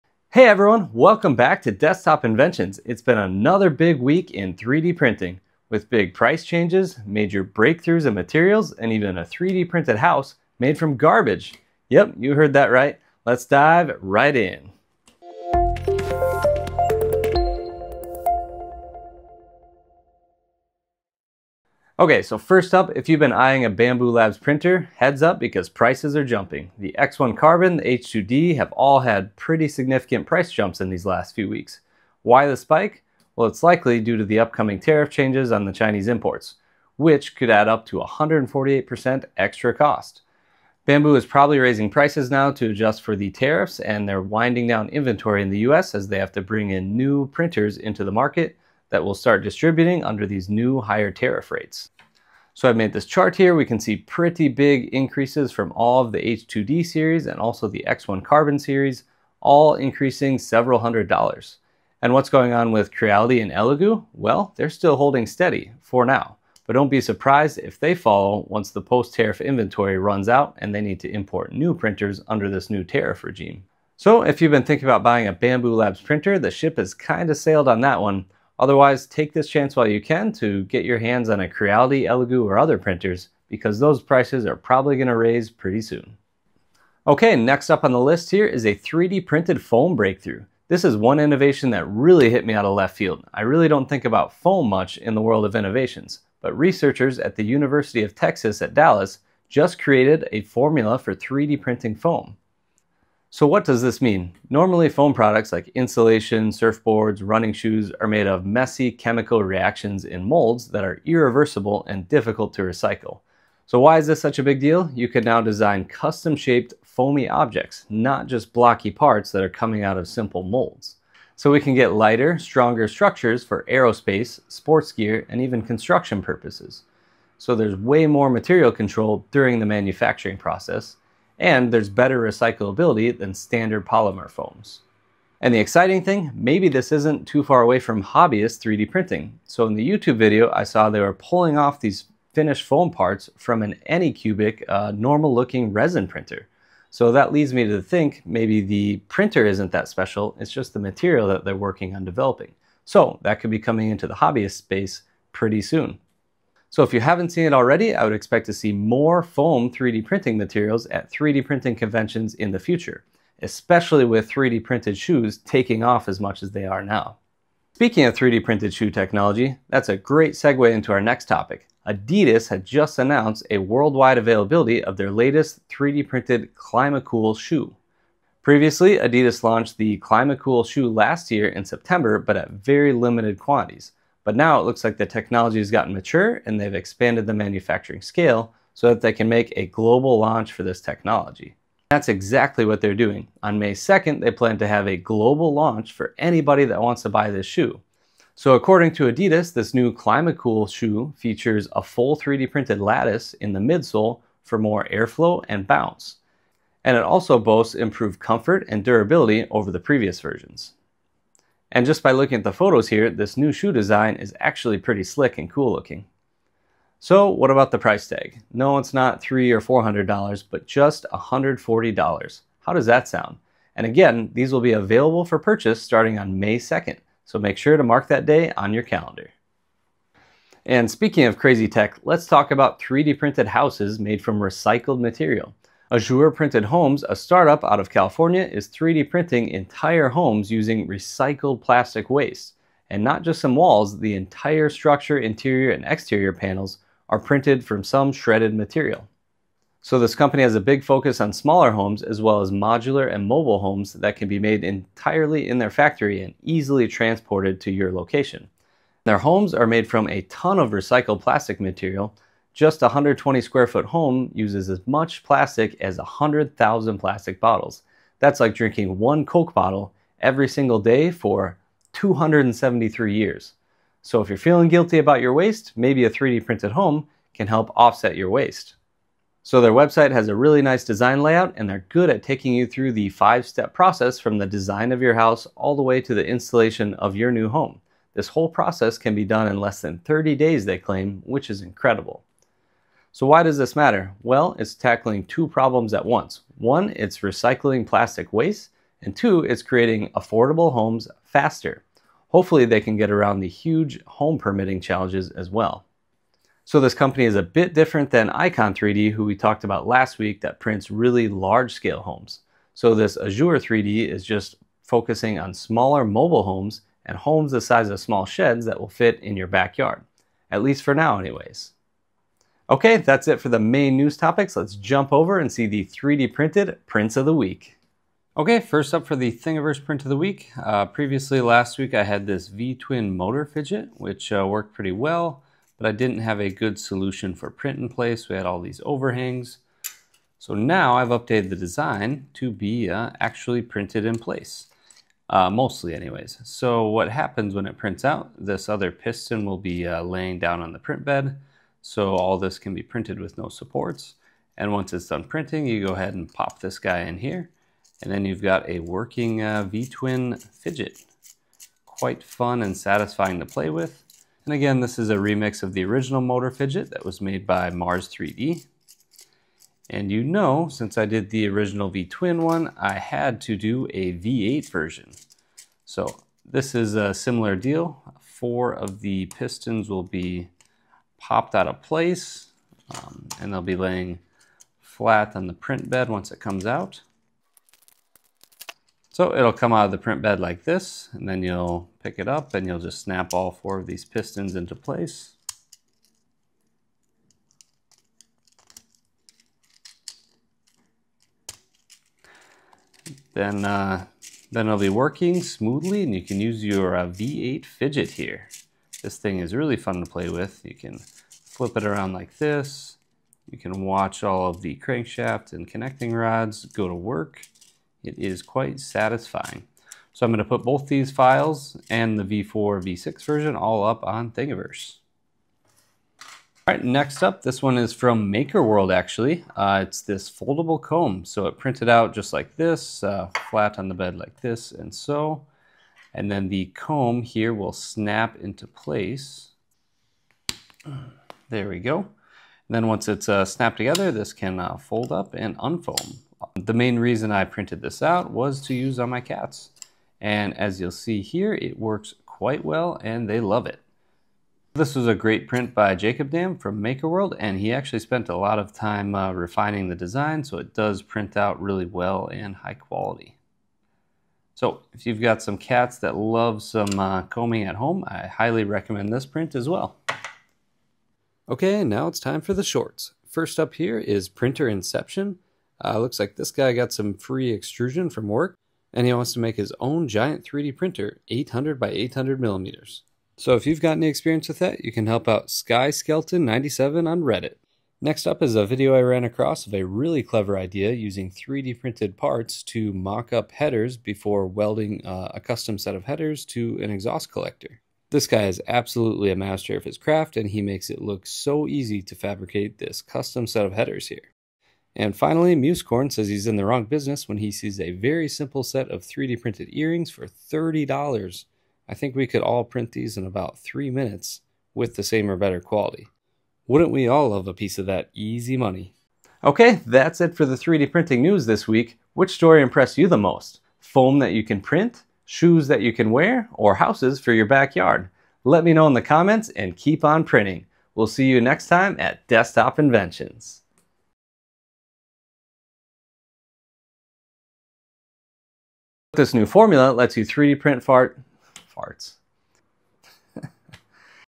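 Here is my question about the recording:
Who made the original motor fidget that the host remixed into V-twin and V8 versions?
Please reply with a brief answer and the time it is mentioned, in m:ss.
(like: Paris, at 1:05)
Mars 3D, at 6:07.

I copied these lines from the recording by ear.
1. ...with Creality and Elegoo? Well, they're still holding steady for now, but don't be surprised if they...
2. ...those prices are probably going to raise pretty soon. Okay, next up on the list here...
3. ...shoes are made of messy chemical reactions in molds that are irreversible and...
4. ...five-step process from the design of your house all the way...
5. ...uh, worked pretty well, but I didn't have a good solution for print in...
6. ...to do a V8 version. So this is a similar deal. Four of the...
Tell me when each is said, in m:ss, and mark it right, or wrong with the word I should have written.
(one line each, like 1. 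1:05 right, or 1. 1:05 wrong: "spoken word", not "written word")
1. 1:02 right
2. 1:23 right
3. 1:47 right
4. 4:43 right
5. 5:34 right
6. 6:13 right.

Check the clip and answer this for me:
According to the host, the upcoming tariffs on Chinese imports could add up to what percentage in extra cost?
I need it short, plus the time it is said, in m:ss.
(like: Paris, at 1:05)
148%, at 0:37.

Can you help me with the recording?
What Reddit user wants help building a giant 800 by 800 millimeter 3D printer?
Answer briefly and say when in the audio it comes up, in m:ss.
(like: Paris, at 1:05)
Sky Skeleton 97, at 8:05.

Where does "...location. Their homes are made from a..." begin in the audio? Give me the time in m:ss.
4:17.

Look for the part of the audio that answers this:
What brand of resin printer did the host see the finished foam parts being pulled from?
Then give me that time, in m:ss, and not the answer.
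2:23.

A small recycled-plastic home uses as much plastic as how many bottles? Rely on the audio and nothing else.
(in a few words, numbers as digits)
100,000.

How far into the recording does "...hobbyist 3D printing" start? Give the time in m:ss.
2:18.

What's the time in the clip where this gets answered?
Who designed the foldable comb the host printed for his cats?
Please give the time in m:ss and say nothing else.
7:35.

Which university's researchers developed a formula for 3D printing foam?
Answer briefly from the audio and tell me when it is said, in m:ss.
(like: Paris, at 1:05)
University of Texas at Dallas, at 1:37.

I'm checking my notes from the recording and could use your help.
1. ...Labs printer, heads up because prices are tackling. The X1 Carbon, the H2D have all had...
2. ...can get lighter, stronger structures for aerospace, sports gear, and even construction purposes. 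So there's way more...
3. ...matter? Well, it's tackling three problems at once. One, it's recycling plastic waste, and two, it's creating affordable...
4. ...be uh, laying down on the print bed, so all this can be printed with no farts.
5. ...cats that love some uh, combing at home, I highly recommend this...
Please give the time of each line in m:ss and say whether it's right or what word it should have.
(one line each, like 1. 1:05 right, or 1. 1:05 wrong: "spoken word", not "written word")
1. 0:24 wrong: "jumping", not "tackling"
2. 2:01 right
3. 4:53 wrong: "two", not "three"
4. 5:49 wrong: "supports", not "farts"
5. 7:45 right.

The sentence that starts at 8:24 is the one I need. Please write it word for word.
And finally, Musecorn says he's in the wrong business when he sees a very simple set of 3D printed earrings for $30.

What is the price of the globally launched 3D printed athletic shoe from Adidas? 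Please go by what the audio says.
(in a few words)
$140.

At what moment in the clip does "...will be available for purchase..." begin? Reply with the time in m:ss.
3:44.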